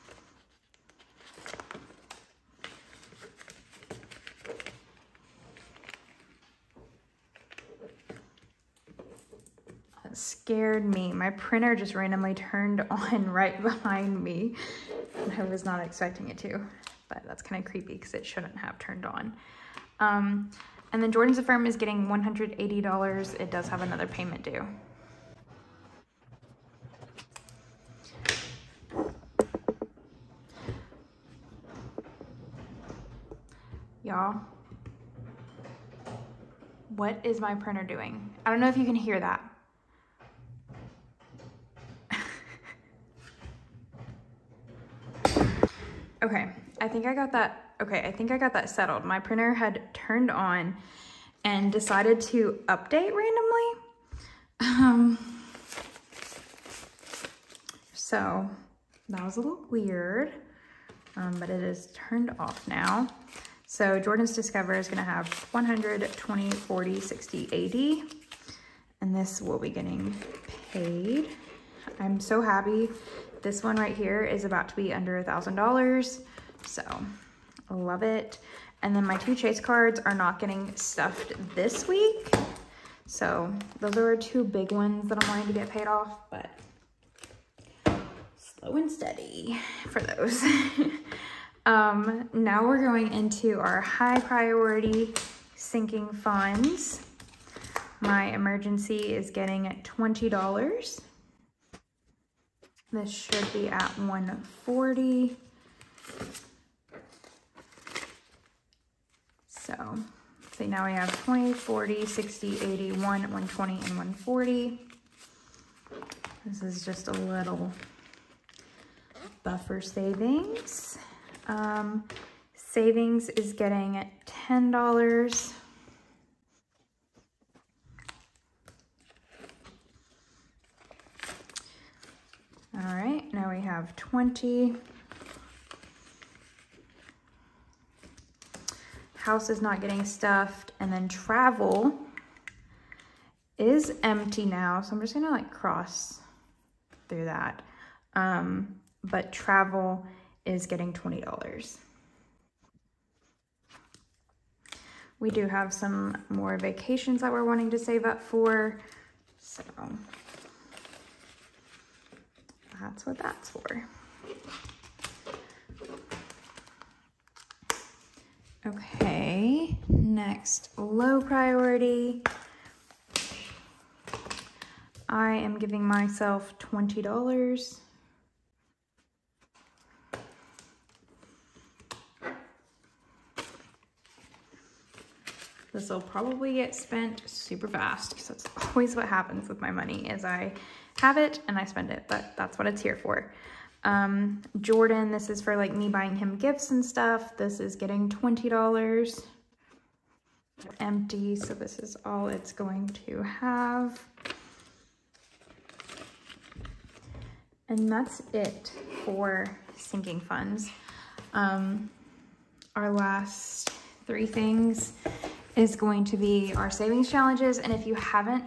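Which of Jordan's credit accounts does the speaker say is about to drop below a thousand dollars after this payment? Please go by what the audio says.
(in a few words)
Discover.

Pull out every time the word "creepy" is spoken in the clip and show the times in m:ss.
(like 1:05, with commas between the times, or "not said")
0:17.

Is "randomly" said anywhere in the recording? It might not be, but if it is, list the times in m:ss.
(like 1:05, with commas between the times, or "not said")
0:11, 0:53.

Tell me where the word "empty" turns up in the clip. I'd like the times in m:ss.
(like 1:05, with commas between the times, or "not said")
2:24, 3:20.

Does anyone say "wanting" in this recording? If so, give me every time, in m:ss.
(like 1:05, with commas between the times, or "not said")
1:25, 2:37.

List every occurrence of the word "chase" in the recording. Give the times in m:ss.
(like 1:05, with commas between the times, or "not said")
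1:19.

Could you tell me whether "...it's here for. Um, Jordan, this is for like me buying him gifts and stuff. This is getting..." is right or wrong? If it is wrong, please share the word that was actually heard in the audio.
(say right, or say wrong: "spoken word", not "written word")
right.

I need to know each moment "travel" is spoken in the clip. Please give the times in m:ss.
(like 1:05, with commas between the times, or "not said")
2:21, 2:29.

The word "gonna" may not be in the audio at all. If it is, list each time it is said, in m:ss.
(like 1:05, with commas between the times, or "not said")
1:04, 2:25.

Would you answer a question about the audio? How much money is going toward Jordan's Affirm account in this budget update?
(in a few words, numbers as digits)
$180.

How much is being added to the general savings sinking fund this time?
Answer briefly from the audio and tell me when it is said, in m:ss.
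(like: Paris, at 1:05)
$10, at 2:04.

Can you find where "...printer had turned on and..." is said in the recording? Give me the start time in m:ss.
0:49.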